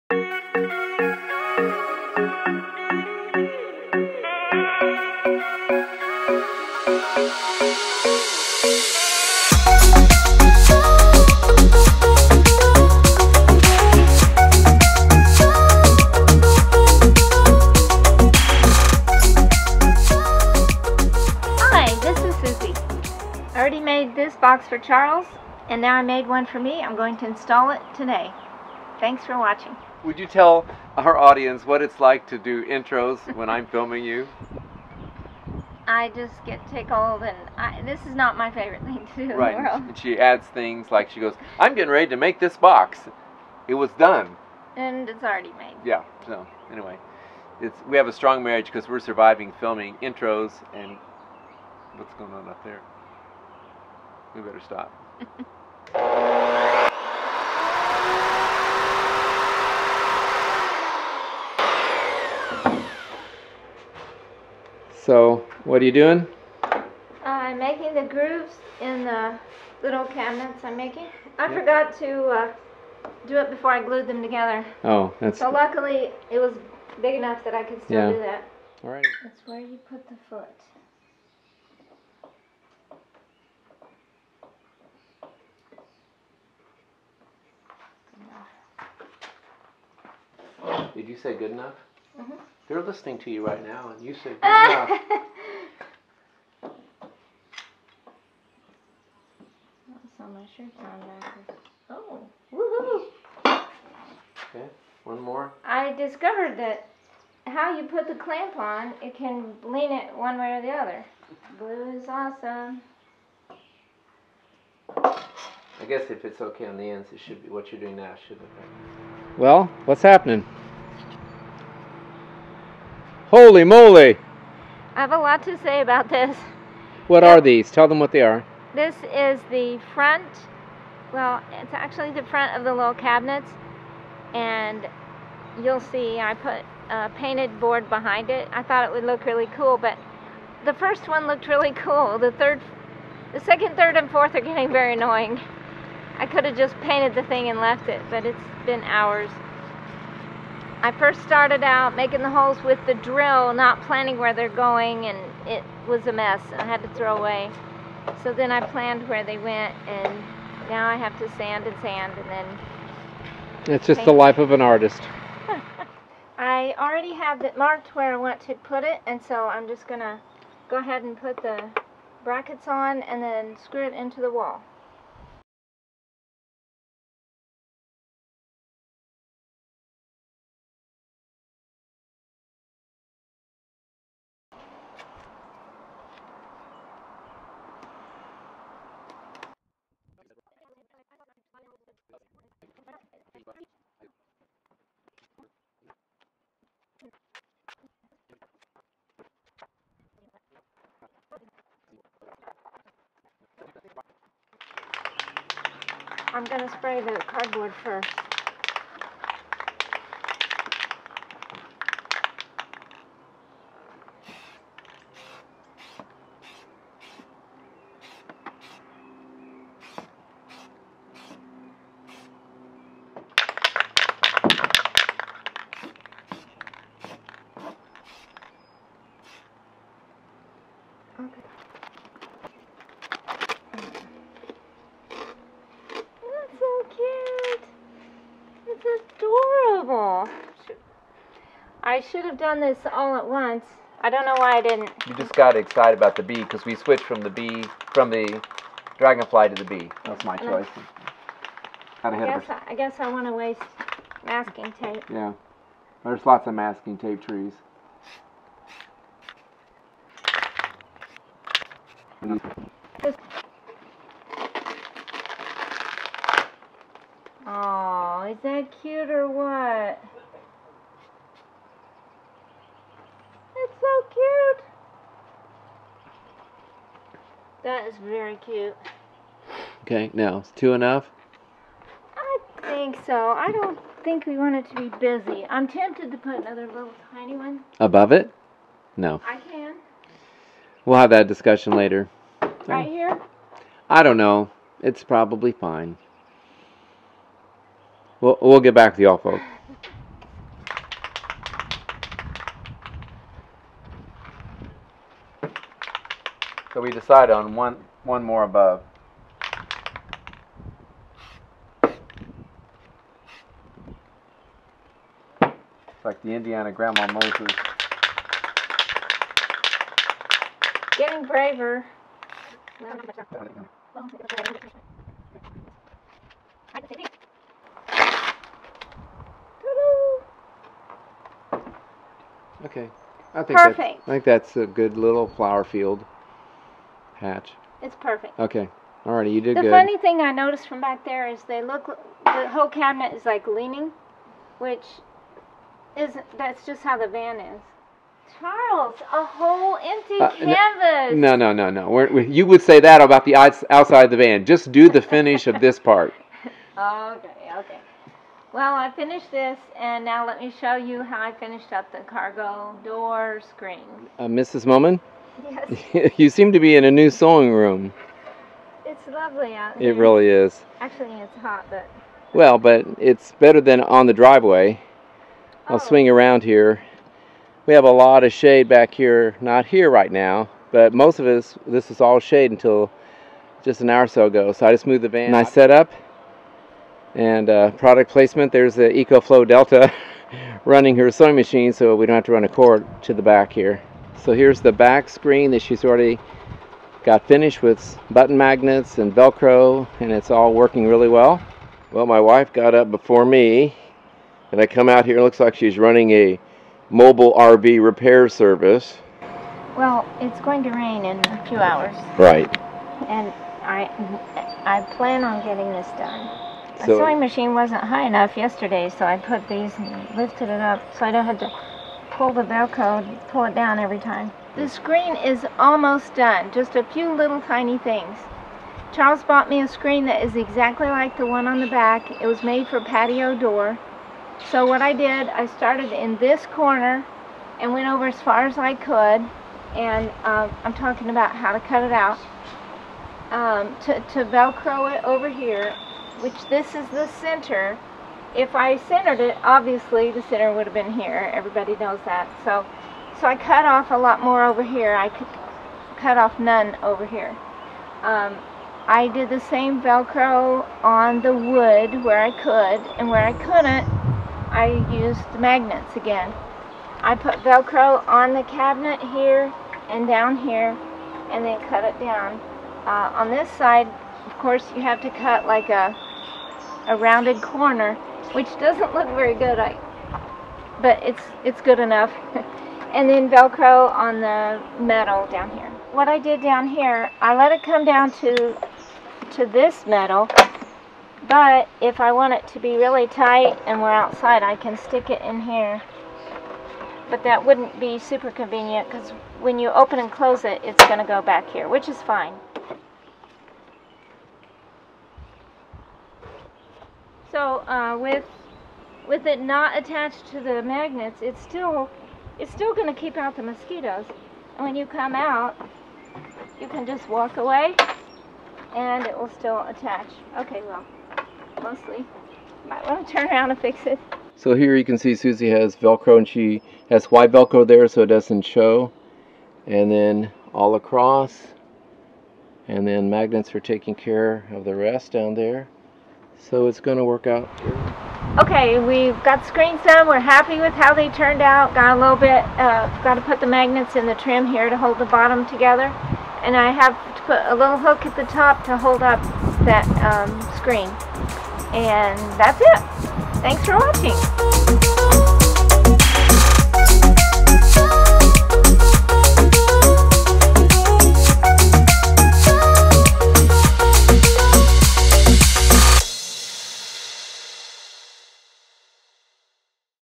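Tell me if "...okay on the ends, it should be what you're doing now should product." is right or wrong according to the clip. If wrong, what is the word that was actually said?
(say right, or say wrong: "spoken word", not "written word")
wrong: "affect", not "product".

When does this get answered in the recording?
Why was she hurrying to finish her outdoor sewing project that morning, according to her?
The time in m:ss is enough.
6:50.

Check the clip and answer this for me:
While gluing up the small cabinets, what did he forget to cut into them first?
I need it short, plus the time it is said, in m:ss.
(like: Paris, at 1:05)
grooves, at 1:08.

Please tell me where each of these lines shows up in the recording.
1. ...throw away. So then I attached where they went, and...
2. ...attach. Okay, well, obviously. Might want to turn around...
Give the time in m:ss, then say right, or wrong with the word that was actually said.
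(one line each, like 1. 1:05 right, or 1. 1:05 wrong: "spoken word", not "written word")
1. 2:36 wrong: "planned", not "attached"
2. 8:39 wrong: "mostly", not "obviously".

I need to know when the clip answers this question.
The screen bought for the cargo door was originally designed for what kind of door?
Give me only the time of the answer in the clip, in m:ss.
7:12.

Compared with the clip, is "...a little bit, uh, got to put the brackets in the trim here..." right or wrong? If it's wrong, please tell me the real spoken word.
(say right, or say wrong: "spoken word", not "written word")
wrong: "magnets", not "brackets".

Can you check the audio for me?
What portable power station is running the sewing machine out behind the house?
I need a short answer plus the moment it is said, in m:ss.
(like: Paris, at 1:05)
EcoFlow Delta, at 6:28.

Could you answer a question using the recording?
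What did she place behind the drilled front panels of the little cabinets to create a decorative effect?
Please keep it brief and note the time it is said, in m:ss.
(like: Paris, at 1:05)
painted board, at 2:17.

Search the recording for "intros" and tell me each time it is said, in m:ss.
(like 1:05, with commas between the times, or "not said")
0:32, 0:50.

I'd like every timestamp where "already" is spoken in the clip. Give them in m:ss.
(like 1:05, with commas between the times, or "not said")
0:45, 2:46, 6:35.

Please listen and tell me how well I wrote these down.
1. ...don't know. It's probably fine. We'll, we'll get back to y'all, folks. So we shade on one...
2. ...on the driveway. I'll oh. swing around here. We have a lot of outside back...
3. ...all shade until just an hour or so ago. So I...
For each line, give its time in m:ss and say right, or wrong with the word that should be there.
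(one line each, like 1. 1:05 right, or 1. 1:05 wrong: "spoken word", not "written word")
1. 4:54 wrong: "decide", not "shade"
2. 6:13 wrong: "shade", not "outside"
3. 6:22 right.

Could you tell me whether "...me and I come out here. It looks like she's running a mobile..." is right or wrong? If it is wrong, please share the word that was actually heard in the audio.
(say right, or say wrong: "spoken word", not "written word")
right.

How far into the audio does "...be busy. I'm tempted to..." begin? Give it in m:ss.
4:44.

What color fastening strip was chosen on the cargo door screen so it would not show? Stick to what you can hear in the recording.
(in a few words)
white.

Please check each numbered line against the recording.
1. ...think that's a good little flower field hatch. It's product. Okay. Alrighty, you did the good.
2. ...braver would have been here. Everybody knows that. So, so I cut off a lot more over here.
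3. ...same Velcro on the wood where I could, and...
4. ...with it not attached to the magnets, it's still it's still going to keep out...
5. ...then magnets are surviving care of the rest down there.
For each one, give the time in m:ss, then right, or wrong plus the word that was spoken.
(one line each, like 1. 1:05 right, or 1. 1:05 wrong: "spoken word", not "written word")
1. 5:34 wrong: "perfect", not "product"
2. 7:30 wrong: "center", not "braver"
3. 7:39 right
4. 8:29 right
5. 8:52 wrong: "taking", not "surviving".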